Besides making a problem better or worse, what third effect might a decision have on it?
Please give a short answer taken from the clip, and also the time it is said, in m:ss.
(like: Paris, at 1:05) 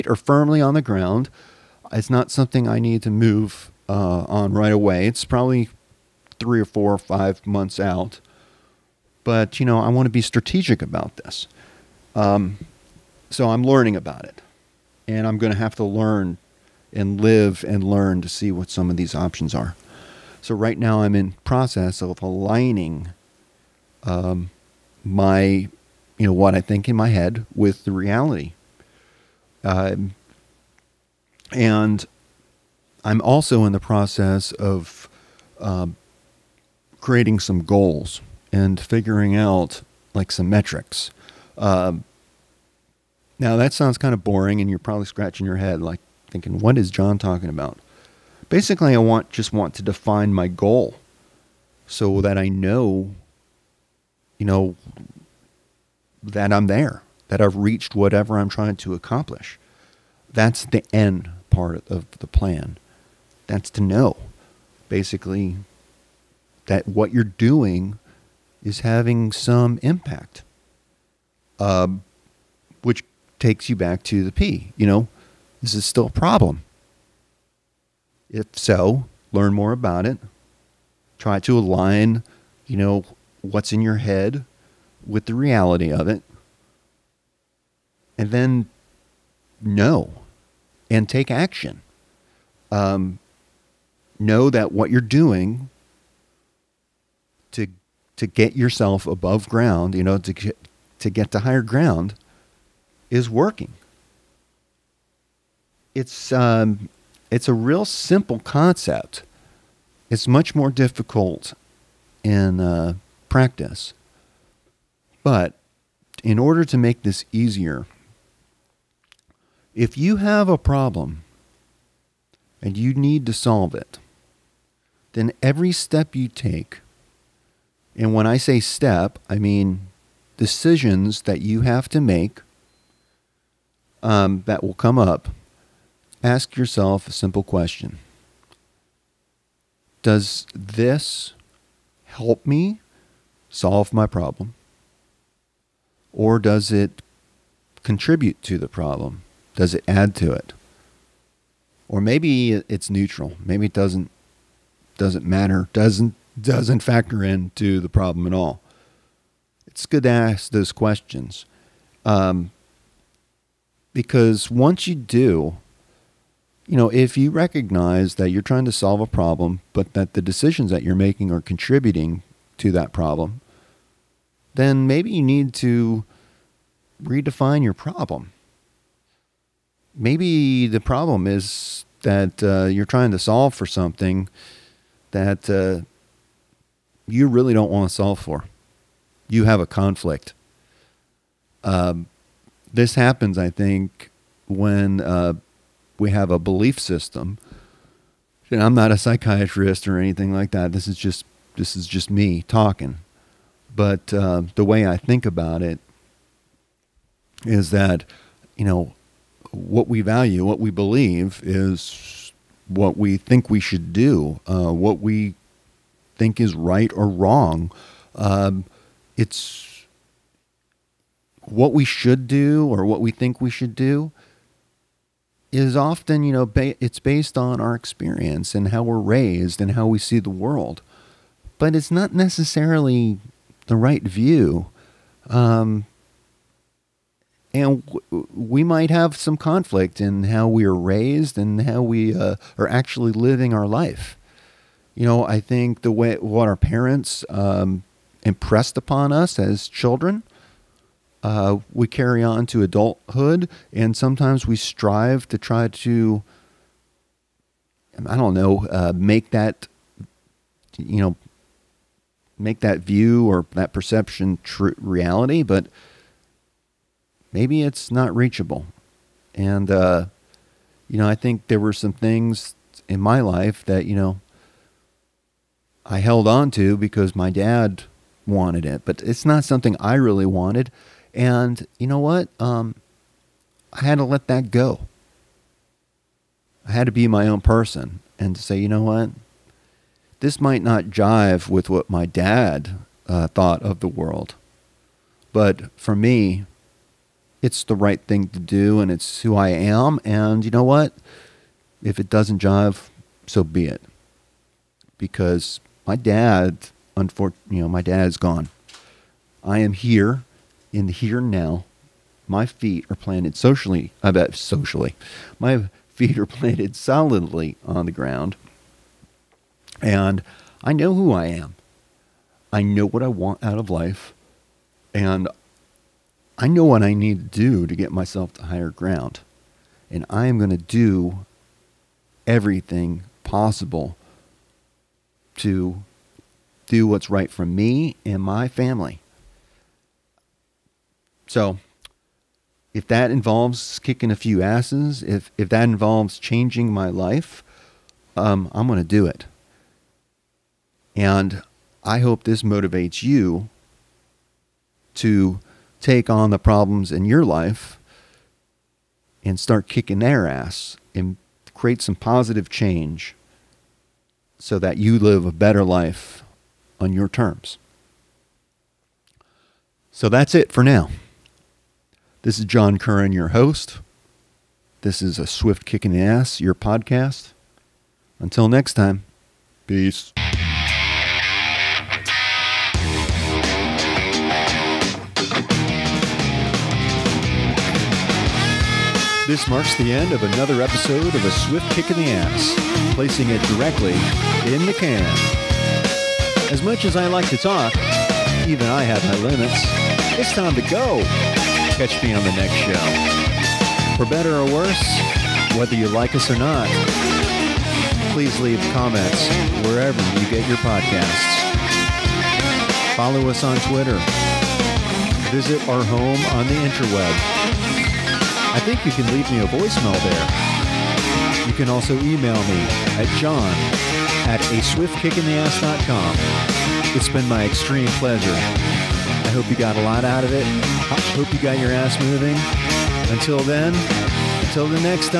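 neutral, at 2:32.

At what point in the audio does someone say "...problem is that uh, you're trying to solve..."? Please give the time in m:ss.
3:00.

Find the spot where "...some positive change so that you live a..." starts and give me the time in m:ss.
6:01.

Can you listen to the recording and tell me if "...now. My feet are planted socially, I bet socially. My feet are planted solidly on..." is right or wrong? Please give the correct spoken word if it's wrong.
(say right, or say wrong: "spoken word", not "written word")
right.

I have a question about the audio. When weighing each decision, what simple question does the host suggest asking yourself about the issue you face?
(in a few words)
Does this help me solve my problem?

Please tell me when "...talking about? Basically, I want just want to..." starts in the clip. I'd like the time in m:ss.
0:47.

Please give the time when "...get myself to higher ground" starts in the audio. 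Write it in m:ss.
5:27.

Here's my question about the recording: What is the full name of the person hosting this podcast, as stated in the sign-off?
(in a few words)
John Curran.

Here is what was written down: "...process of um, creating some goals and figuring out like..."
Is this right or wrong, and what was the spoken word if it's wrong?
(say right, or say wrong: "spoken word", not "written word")
right.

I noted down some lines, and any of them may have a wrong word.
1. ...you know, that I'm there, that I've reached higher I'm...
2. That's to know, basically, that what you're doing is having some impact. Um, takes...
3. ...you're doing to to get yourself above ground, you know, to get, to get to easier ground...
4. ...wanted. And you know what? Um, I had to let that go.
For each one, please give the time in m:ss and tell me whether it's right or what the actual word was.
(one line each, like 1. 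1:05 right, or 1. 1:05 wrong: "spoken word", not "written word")
1. 0:54 wrong: "whatever", not "higher"
2. 1:03 right
3. 1:34 wrong: "higher", not "easier"
4. 4:40 right.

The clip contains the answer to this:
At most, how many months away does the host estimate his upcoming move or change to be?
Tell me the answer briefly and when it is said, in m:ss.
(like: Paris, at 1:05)
5, at 0:06.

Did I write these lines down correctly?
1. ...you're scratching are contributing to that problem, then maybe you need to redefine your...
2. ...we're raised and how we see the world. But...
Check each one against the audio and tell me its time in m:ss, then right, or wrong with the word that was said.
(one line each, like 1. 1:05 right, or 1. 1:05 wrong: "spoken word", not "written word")
1. 2:50 wrong: "making", not "scratching"
2. 3:48 right.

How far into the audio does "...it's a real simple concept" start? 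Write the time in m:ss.
1:47.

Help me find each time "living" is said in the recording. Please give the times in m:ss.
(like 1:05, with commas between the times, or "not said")
4:03.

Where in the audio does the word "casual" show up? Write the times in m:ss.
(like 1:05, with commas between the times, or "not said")
not said.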